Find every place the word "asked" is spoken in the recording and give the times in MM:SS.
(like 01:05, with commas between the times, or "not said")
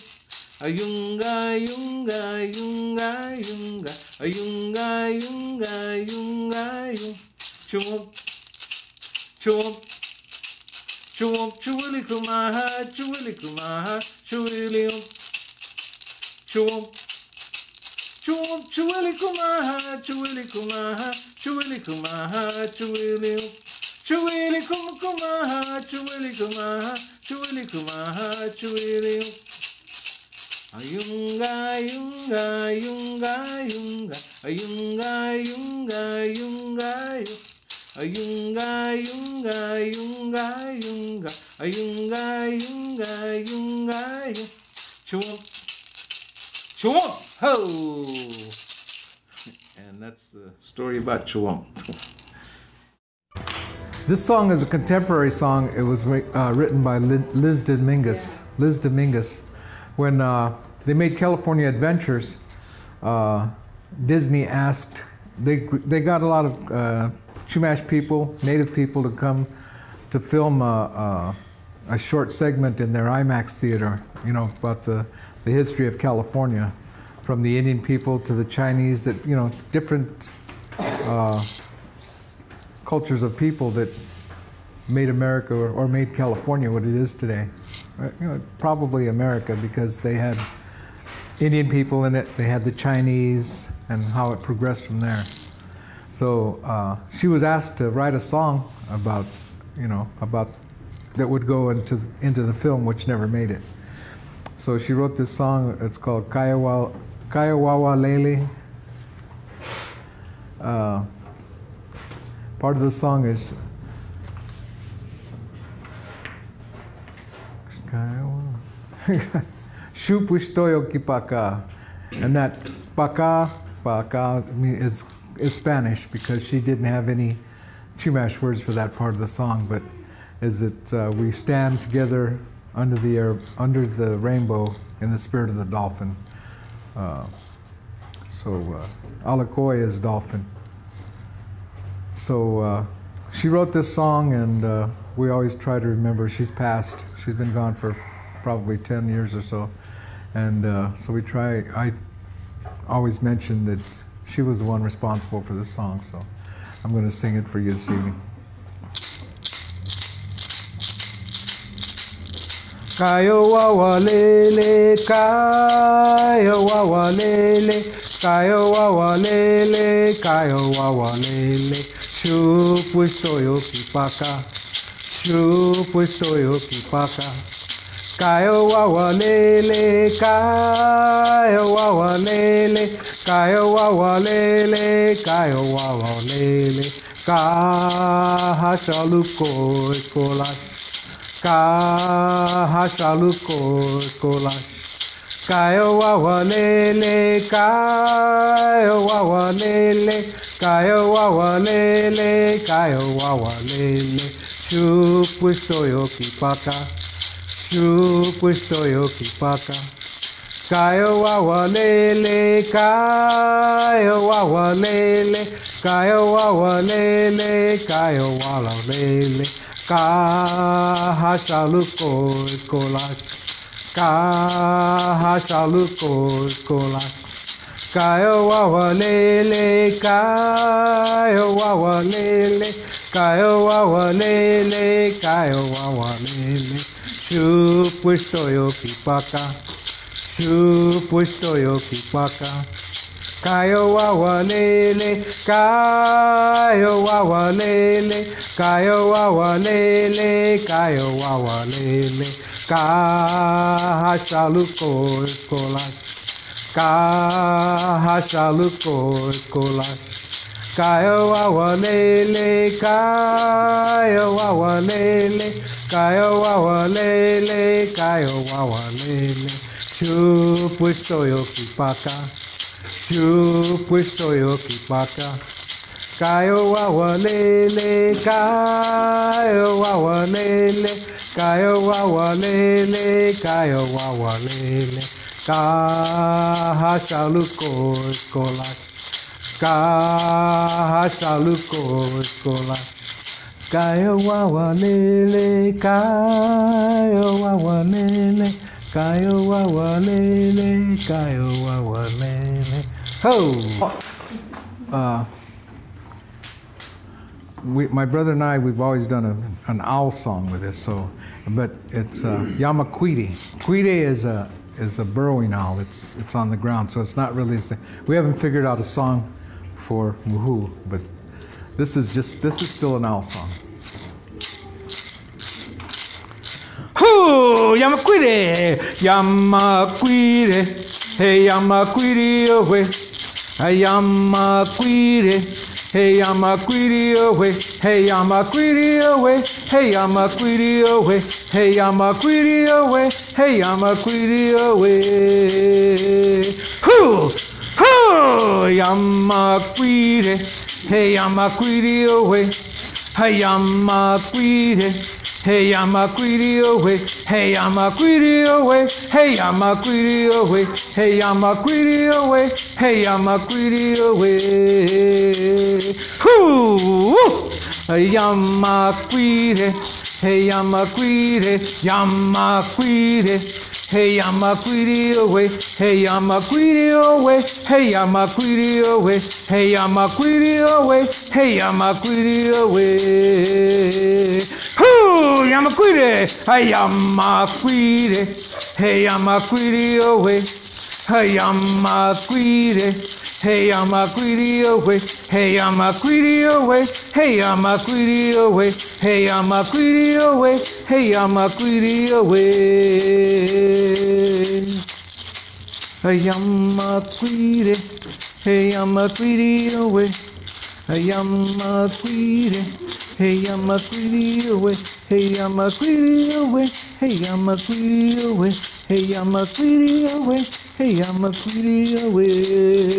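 01:04, 01:37.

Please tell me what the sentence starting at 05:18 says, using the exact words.
We haven't figured out a song for Muhu, but this is just this is still an owl song.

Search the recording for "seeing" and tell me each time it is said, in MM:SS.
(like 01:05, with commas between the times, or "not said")
not said.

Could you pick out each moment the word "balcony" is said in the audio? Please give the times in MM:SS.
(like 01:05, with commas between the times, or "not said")
not said.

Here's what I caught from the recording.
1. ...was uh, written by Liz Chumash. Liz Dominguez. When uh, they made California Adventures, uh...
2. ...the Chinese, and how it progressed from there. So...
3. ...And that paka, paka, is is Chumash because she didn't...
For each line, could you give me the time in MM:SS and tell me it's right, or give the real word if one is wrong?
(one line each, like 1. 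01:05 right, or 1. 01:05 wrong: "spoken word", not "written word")
1. 00:55 wrong: "Dominguez", not "Chumash"
2. 01:32 right
3. 02:02 wrong: "Spanish", not "Chumash".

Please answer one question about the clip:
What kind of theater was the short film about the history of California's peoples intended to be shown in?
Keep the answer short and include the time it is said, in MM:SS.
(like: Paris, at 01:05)
IMAX, at 01:13.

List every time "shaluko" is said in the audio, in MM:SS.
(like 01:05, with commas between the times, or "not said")
03:41, 03:45.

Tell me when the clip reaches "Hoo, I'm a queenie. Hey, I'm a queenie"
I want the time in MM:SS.
06:24.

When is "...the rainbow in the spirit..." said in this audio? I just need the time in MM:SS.
02:13.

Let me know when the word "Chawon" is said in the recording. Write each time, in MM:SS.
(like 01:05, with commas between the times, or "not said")
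00:46, 00:51.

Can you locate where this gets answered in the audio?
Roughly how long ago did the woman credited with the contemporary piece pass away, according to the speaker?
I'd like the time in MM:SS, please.
02:28.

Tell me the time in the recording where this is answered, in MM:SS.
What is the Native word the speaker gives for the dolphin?
02:19.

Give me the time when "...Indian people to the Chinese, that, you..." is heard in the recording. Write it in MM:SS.
01:17.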